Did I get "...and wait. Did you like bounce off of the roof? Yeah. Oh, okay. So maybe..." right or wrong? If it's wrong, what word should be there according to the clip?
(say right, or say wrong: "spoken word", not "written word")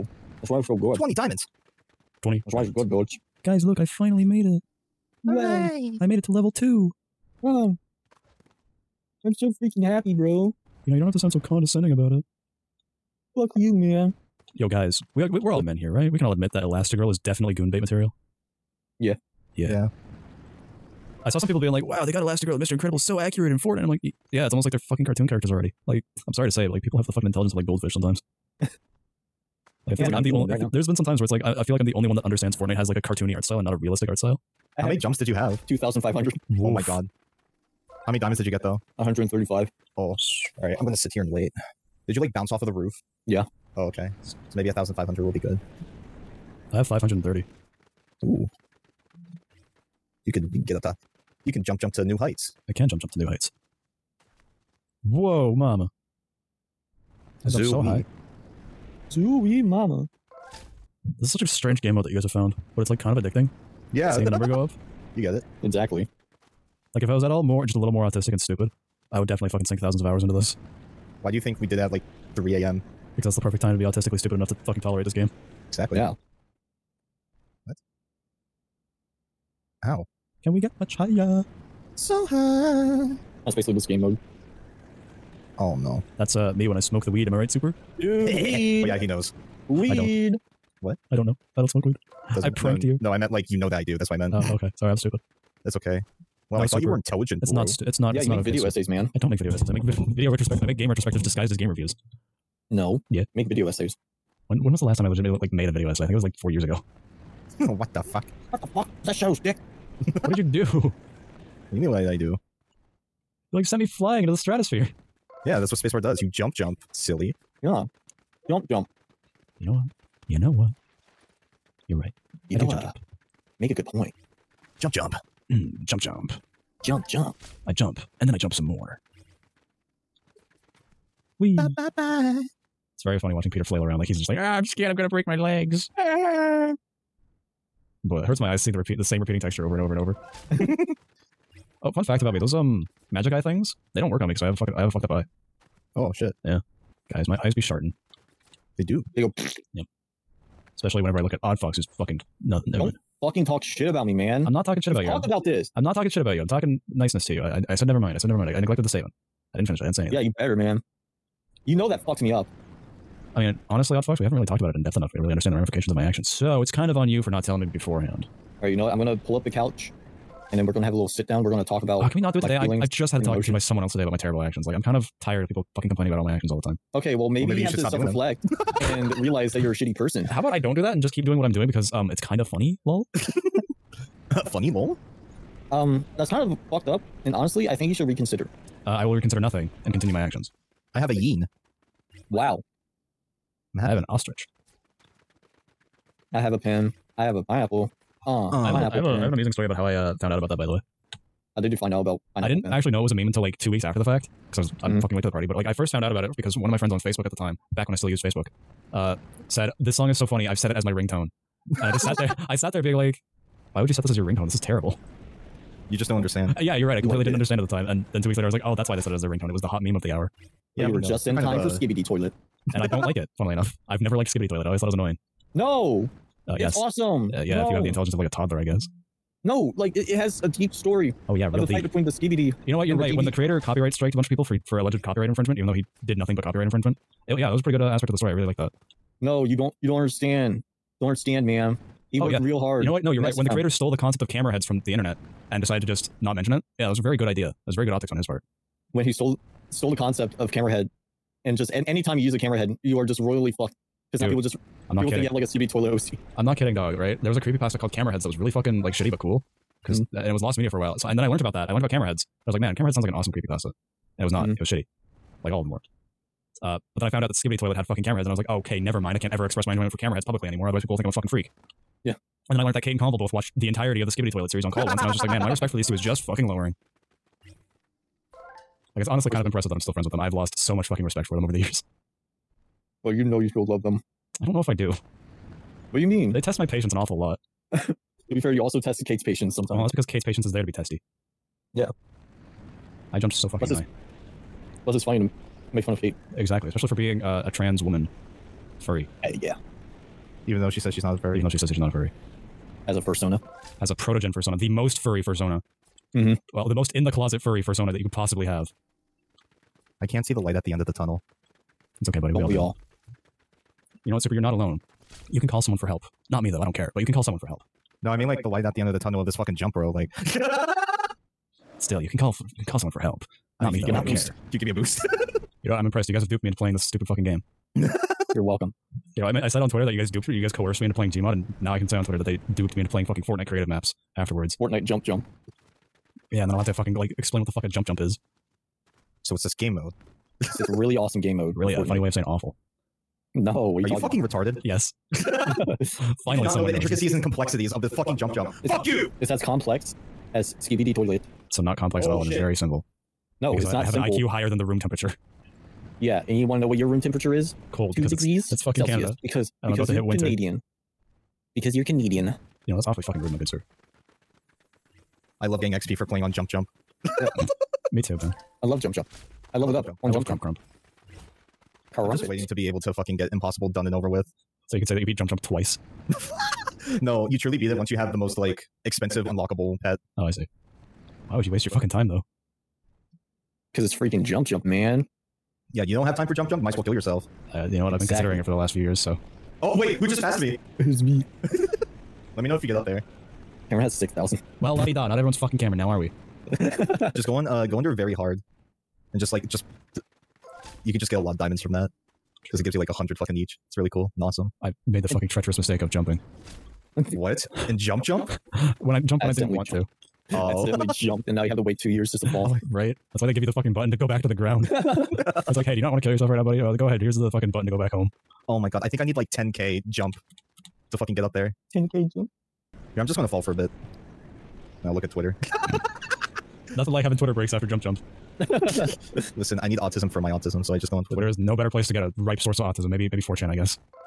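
right.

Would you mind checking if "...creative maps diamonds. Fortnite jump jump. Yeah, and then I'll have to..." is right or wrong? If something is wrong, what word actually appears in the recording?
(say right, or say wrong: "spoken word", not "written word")
wrong: "afterwards", not "diamonds".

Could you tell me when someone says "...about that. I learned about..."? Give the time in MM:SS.
04:21.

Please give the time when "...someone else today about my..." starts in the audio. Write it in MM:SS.
02:53.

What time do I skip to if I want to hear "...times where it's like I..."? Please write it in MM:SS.
00:31.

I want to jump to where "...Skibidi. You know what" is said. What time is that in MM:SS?
03:52.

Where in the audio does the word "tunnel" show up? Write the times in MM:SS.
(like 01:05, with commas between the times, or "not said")
05:10, 05:18.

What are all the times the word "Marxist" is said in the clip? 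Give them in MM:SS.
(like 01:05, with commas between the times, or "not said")
not said.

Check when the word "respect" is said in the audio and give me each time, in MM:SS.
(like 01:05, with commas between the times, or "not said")
04:35, 04:41.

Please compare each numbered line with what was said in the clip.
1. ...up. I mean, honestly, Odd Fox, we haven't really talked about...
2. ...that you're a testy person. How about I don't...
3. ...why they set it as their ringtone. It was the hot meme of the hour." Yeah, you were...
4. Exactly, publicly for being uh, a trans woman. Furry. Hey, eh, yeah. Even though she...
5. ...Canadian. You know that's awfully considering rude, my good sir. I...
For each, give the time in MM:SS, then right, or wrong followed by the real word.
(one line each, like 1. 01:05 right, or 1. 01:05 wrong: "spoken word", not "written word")
1. 02:42 right
2. 02:59 wrong: "shitty", not "testy"
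3. 03:38 right
4. 04:56 wrong: "especially", not "publicly"
5. 06:01 wrong: "fucking", not "considering".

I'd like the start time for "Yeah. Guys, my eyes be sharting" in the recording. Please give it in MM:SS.
02:26.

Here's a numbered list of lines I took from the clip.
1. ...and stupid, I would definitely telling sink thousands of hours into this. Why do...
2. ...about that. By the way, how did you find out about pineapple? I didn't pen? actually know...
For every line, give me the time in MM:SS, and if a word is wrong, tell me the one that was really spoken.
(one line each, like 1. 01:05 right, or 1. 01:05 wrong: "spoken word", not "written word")
1. 01:08 wrong: "fucking", not "telling"
2. 03:20 right.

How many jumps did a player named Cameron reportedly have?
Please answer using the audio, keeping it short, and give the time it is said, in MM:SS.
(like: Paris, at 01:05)
6000, at 06:33.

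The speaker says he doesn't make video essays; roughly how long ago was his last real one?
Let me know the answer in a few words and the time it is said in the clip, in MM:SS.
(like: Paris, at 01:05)
4 years ago, at 01:46.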